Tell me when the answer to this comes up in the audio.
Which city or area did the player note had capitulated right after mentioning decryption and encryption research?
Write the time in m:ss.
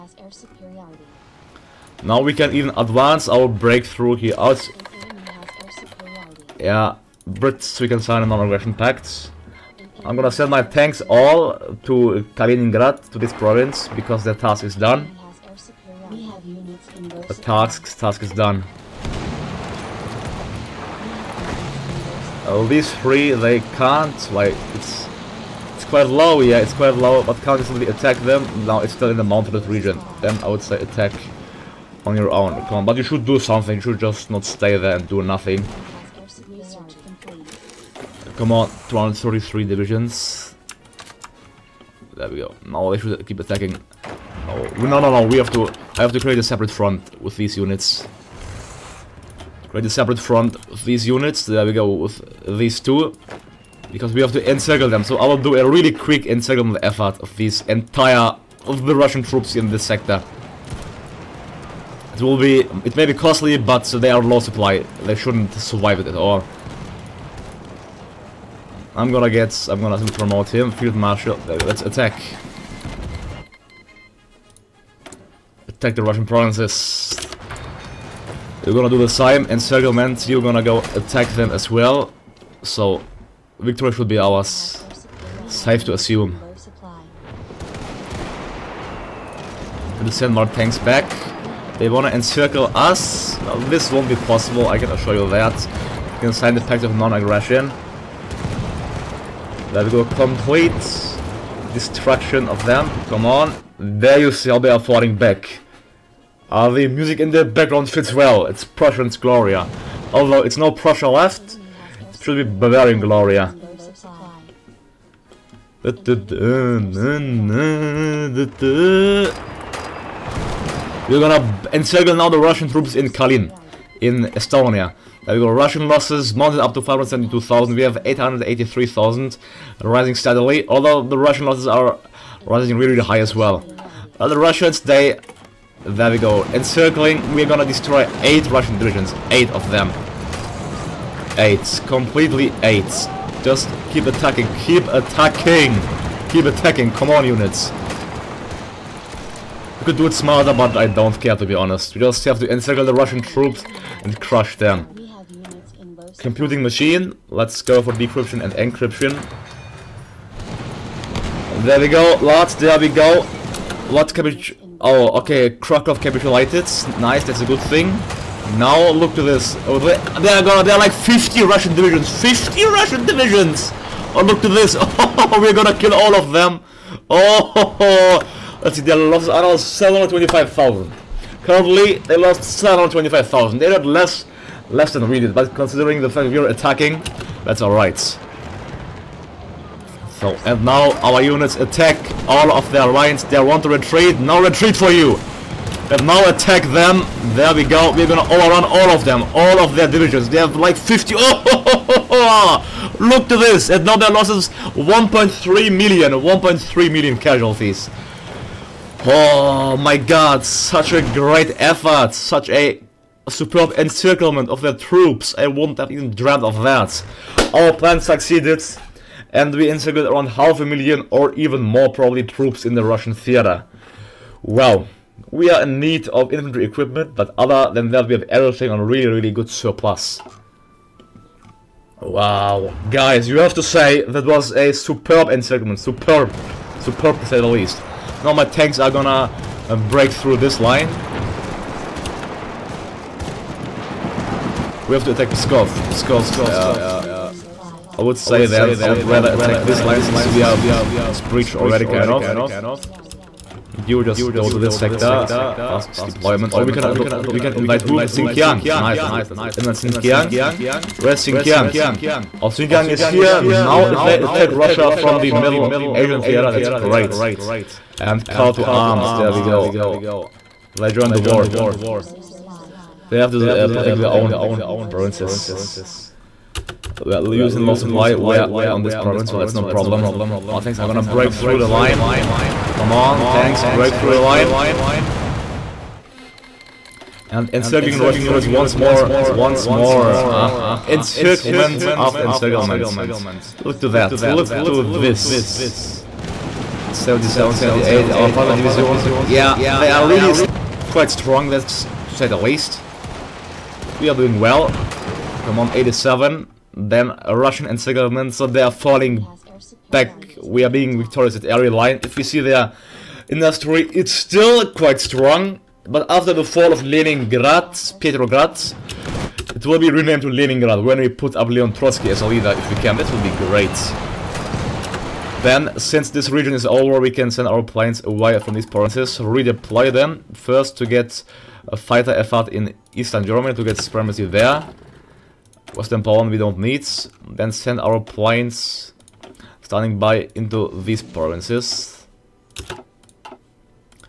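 2:45.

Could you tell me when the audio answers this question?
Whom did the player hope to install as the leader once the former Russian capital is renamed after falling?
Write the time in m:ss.
5:21.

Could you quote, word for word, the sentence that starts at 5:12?
If you see their industry, it's still quite strong.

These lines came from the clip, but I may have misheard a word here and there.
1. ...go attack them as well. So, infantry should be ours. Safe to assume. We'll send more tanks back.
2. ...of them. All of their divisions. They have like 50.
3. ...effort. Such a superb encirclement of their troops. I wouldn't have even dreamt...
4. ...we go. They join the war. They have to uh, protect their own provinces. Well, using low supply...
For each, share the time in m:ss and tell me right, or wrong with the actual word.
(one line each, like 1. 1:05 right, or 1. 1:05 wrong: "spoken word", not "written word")
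1. 1:20 wrong: "victory", not "infantry"
2. 3:18 right
3. 3:31 right
4. 4:29 right.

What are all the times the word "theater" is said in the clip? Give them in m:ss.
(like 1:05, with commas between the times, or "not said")
3:43, 4:26.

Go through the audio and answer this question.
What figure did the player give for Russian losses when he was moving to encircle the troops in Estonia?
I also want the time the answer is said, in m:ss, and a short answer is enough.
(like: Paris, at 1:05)
572,000, at 2:06.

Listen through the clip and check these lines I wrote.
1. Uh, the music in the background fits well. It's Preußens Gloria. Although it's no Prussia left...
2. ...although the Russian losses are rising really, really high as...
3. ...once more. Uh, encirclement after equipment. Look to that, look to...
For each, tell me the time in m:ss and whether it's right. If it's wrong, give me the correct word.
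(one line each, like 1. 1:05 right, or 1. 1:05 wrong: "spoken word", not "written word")
1. 1:46 right
2. 2:10 right
3. 4:49 wrong: "encirclement", not "equipment".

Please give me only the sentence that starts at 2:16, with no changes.
Encircling, we're gonna destroy 8 Russian divisions.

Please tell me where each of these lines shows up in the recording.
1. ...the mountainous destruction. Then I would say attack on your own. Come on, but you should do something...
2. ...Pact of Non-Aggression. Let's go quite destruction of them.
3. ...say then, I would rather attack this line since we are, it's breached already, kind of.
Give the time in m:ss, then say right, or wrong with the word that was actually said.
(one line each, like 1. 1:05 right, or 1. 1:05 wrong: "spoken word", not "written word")
1. 0:29 wrong: "region", not "destruction"
2. 1:36 wrong: "complete", not "quite"
3. 4:08 right.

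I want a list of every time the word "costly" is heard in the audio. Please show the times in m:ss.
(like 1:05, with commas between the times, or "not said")
1:03.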